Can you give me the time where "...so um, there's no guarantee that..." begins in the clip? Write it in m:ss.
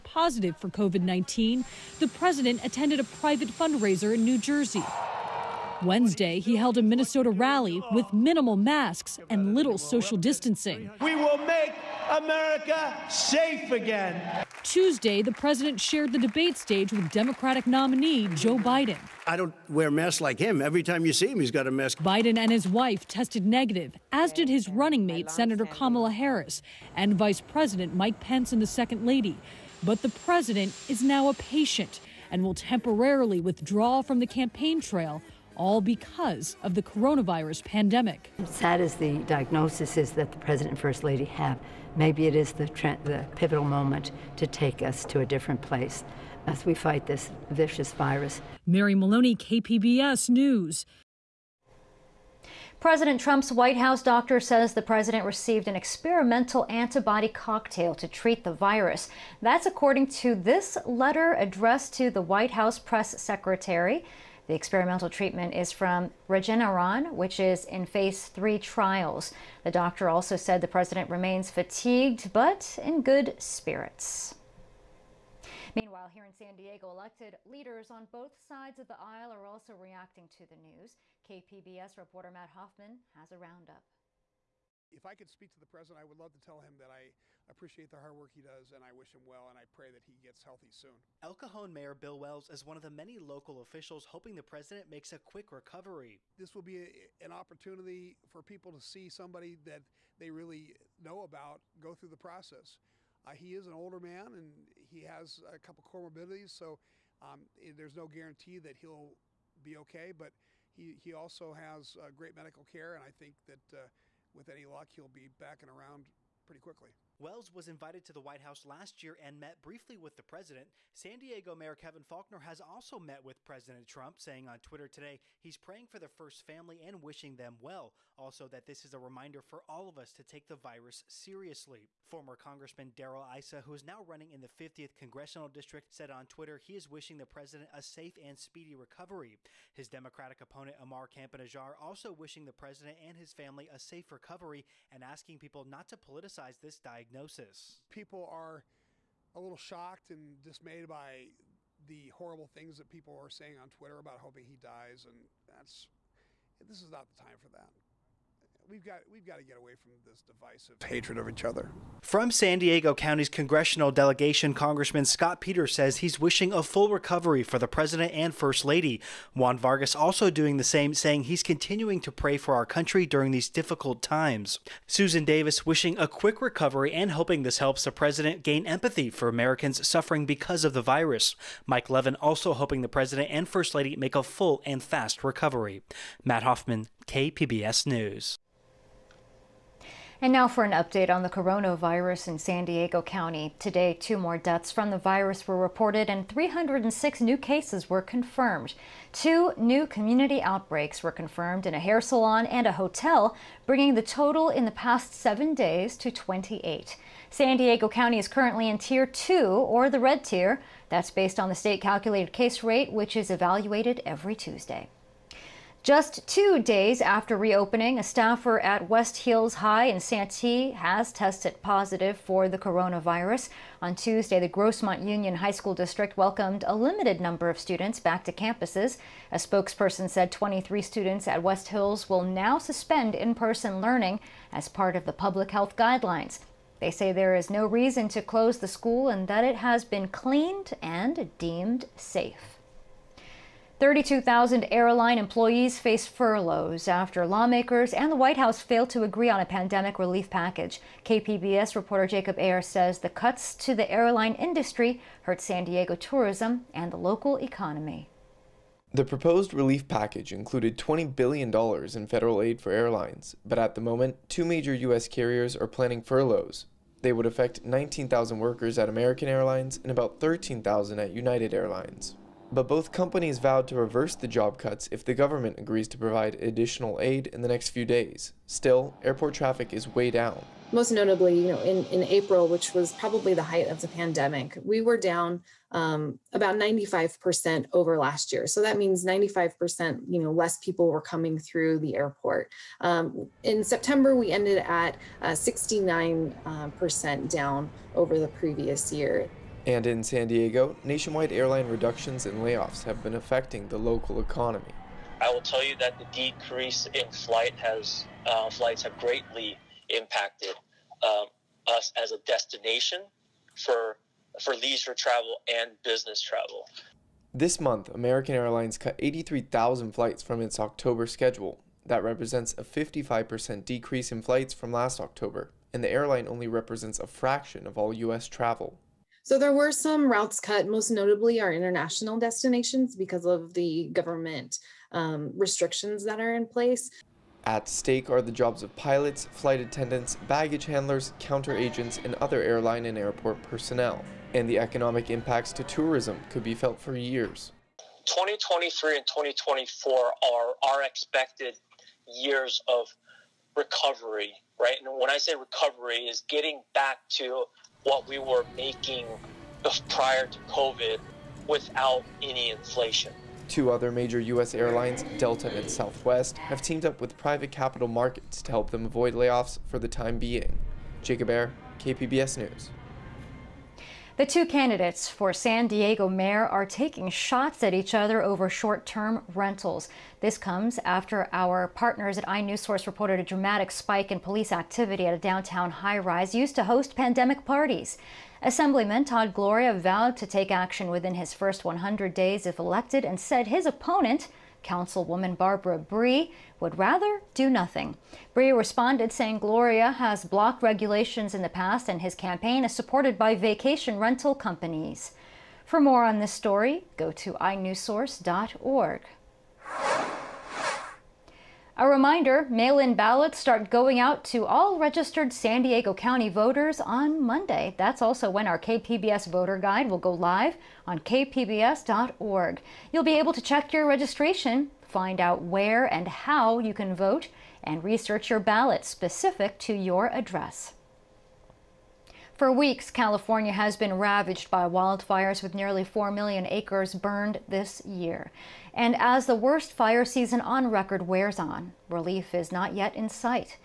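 1:46.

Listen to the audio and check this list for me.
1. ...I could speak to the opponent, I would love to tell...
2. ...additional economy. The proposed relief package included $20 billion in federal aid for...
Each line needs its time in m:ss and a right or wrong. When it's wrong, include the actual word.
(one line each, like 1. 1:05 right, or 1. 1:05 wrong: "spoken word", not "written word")
1. 1:25 wrong: "president", not "opponent"
2. 4:16 wrong: "local", not "additional".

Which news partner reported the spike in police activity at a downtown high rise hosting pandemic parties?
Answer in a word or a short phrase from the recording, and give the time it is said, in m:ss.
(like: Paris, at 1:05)
inewsource, at 6:22.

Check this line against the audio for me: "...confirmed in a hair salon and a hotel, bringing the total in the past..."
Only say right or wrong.
right.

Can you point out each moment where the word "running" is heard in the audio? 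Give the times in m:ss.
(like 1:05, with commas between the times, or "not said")
0:24, 2:14.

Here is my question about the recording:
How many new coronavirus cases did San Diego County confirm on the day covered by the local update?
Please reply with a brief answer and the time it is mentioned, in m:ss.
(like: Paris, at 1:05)
306, at 3:16.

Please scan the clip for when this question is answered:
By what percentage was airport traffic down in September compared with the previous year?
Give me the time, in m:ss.
4:55.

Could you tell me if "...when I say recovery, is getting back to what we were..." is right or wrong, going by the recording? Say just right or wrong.
right.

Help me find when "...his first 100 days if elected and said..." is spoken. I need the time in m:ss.
6:31.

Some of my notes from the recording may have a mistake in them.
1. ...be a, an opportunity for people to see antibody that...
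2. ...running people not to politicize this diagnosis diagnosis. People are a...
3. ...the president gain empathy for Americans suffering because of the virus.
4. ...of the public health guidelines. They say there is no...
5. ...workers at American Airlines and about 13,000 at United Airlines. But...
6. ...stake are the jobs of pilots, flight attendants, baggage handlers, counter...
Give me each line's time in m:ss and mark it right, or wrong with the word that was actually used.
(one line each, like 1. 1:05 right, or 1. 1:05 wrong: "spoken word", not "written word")
1. 1:36 wrong: "somebody", not "antibody"
2. 2:25 wrong: "asking", not "running"
3. 2:57 right
4. 3:54 right
5. 4:28 right
6. 5:37 right.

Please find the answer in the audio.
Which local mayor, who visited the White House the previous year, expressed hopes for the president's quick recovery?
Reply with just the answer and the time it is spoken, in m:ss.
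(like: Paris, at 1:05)
Bill Wells, at 1:31.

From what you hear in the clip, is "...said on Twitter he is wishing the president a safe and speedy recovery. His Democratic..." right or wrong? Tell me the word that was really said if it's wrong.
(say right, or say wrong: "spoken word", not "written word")
right.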